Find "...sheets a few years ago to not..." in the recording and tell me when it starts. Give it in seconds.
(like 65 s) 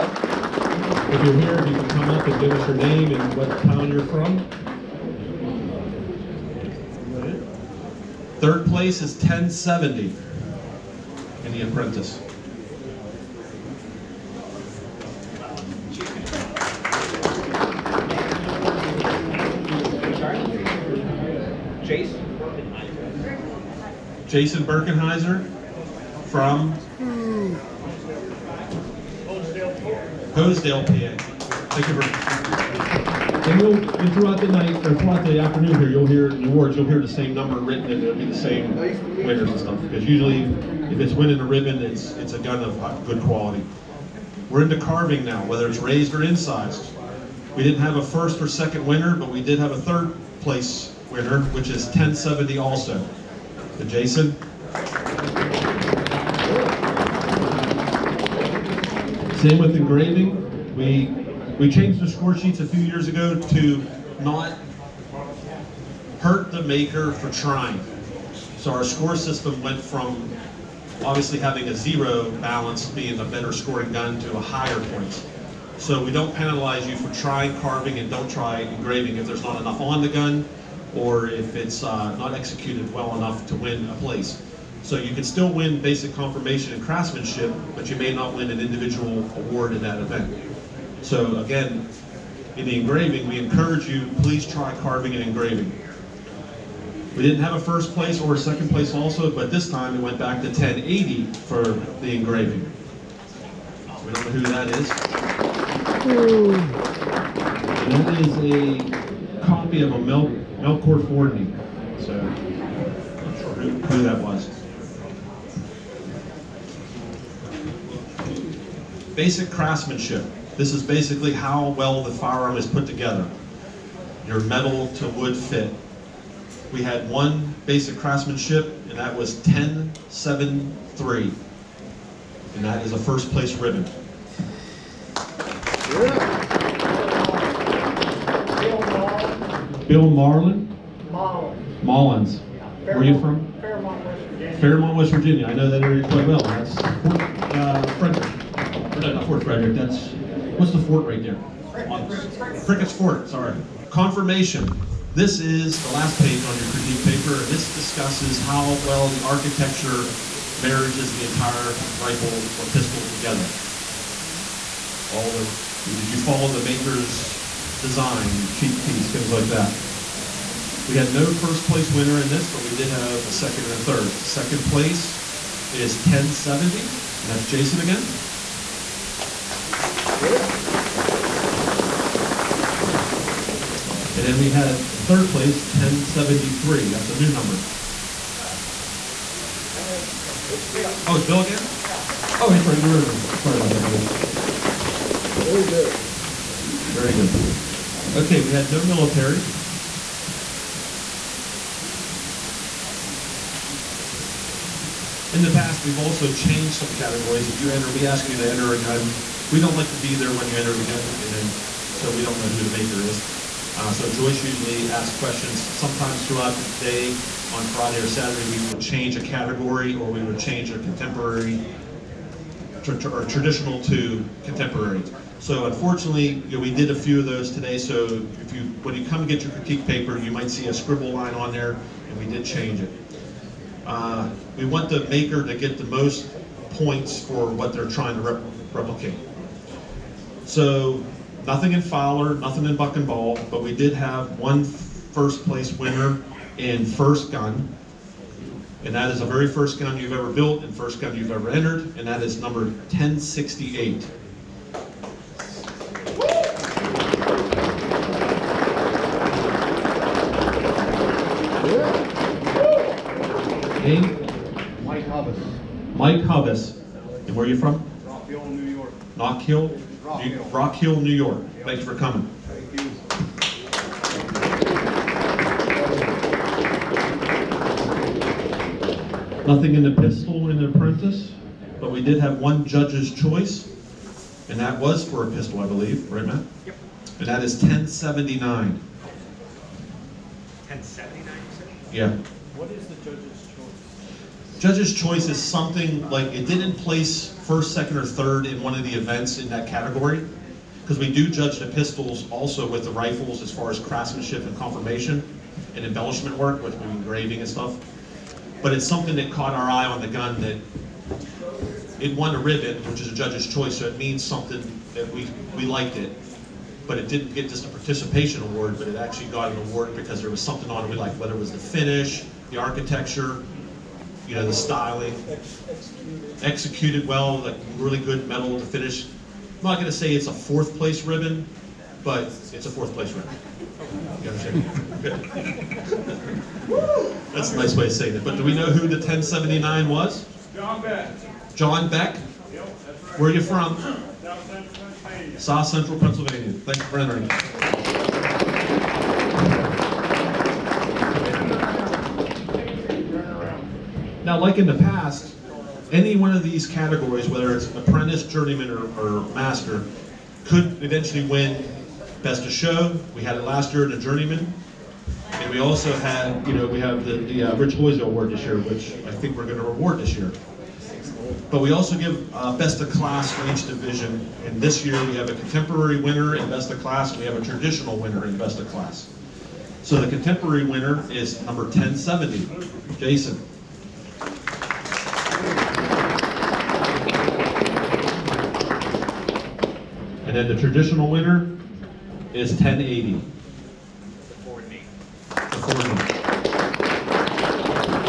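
62 s.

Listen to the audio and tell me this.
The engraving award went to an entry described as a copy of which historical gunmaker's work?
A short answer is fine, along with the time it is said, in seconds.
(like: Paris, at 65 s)
Melchior Fordney, at 110 s.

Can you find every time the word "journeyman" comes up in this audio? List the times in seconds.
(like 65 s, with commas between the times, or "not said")
358 s, 363 s.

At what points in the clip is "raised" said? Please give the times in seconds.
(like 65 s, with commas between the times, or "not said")
45 s.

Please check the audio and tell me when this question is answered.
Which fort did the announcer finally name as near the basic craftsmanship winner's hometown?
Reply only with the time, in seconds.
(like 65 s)
152 s.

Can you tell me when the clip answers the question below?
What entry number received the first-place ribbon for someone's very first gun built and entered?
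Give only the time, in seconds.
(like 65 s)
252 s.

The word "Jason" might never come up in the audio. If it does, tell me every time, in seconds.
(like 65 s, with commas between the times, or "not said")
24 s, 53 s, 177 s, 382 s.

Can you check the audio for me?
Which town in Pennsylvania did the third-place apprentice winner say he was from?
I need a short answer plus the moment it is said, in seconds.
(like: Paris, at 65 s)
Hosedale, PA, at 30 s.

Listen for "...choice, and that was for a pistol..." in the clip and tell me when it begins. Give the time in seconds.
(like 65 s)
283 s.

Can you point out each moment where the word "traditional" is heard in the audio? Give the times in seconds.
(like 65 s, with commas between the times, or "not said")
223 s, 377 s, 390 s.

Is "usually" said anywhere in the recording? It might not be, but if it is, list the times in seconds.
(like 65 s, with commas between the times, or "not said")
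40 s, 214 s.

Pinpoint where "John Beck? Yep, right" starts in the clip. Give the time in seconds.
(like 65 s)
341 s.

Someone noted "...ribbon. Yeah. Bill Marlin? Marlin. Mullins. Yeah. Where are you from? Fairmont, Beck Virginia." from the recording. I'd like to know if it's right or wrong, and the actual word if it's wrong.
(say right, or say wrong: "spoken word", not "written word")
wrong: "West", not "Beck".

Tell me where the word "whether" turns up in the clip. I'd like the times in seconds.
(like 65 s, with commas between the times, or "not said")
45 s, 321 s, 357 s.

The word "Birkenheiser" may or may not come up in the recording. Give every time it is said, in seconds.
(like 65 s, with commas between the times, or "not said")
24 s.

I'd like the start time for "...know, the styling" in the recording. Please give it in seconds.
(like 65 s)
324 s.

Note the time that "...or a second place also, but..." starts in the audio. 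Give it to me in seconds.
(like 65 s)
98 s.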